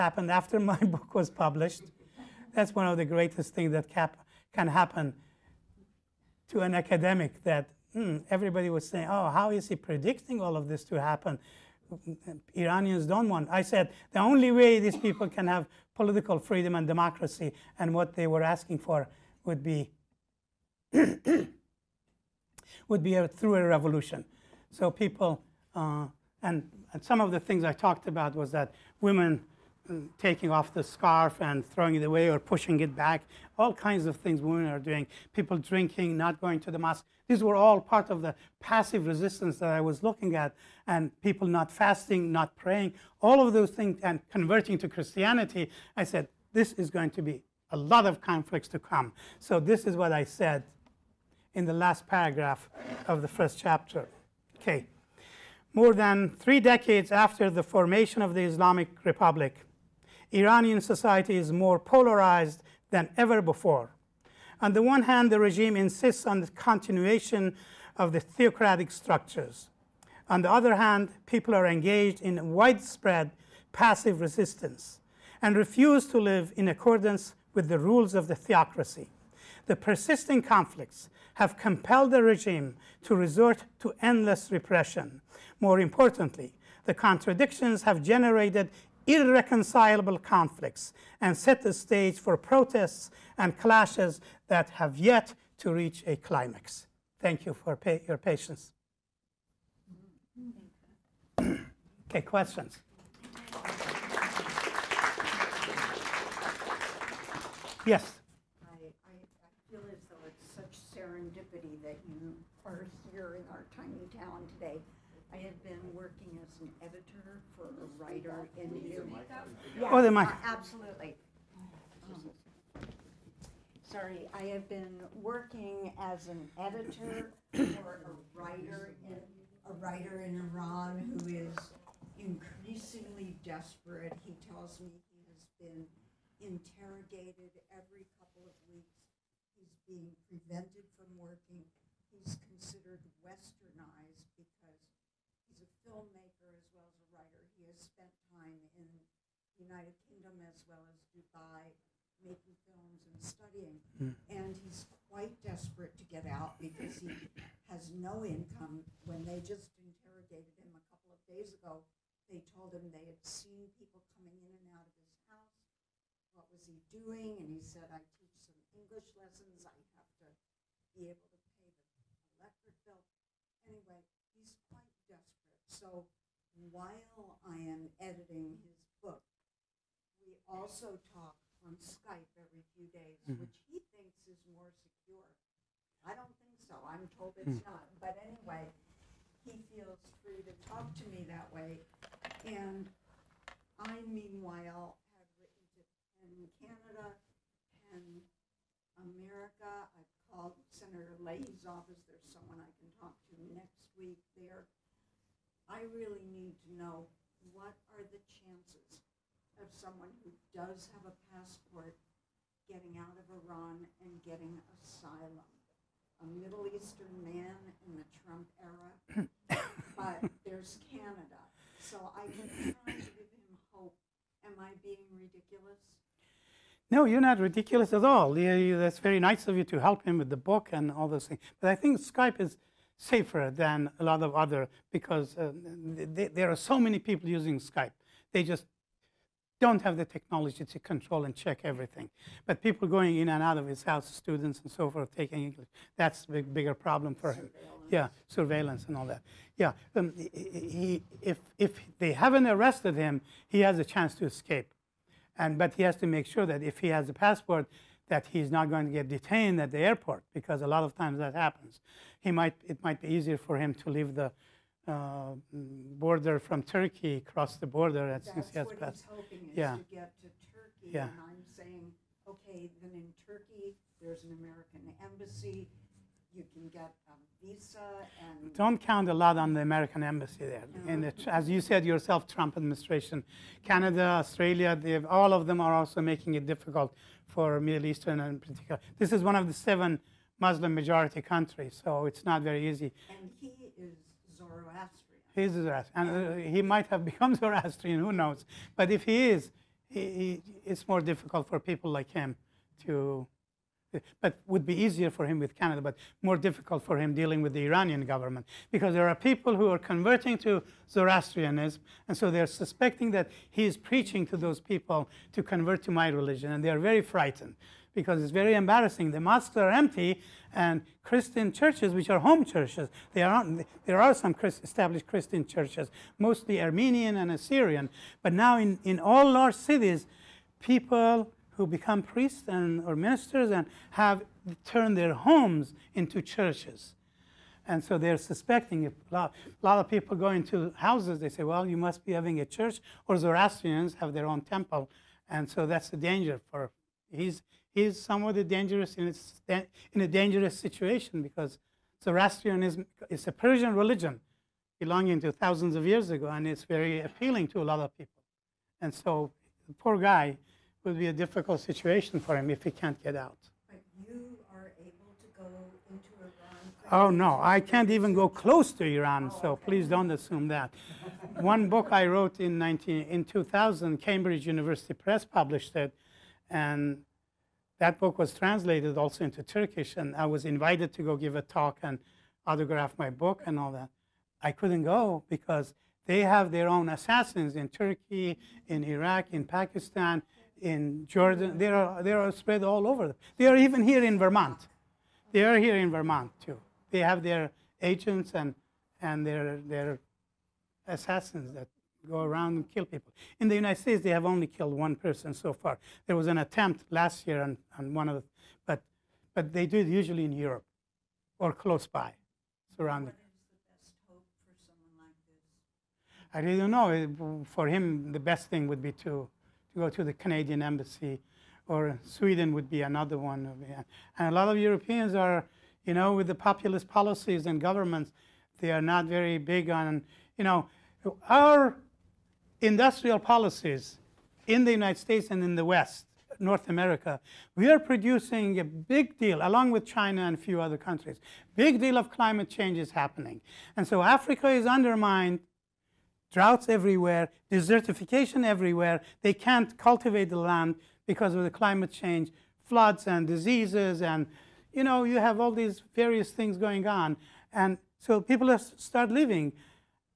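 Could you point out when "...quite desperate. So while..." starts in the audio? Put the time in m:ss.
2:54.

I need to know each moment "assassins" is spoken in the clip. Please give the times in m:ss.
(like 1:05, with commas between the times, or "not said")
6:26, 6:40.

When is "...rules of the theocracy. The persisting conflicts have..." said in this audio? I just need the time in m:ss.
1:17.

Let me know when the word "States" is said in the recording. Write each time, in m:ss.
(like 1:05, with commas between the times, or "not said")
6:43, 7:14.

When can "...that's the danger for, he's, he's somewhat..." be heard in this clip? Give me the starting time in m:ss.
5:45.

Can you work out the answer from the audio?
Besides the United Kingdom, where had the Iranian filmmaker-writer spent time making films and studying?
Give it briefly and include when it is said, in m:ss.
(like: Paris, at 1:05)
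Dubai, at 2:31.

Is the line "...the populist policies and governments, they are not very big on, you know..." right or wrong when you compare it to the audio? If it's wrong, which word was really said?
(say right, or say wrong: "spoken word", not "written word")
right.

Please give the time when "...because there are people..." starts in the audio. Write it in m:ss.
5:08.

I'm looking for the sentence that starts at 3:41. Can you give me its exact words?
So I keep trying to give him hope.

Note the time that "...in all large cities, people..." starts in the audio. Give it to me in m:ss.
5:28.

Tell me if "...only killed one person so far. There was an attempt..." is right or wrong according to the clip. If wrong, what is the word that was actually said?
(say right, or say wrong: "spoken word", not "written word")
right.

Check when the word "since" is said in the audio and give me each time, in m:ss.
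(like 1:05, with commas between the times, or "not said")
4:28.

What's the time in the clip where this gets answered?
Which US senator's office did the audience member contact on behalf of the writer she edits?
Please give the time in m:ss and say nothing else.
3:20.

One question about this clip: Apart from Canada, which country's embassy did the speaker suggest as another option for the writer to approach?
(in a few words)
Sweden.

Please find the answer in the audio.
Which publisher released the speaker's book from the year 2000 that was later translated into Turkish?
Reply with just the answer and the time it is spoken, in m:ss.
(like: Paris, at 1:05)
Cambridge University Press, at 6:13.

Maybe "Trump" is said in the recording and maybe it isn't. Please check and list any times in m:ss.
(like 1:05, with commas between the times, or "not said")
3:38, 4:42.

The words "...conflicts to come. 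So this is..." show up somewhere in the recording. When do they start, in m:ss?
0:48.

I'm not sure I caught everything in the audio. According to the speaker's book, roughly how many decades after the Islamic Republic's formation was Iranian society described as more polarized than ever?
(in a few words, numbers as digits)
More than 3 decades.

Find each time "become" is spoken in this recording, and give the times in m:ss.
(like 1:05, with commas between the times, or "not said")
4:57, 5:31.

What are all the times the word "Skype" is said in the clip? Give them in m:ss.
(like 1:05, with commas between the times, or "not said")
3:01, 3:51, 3:57.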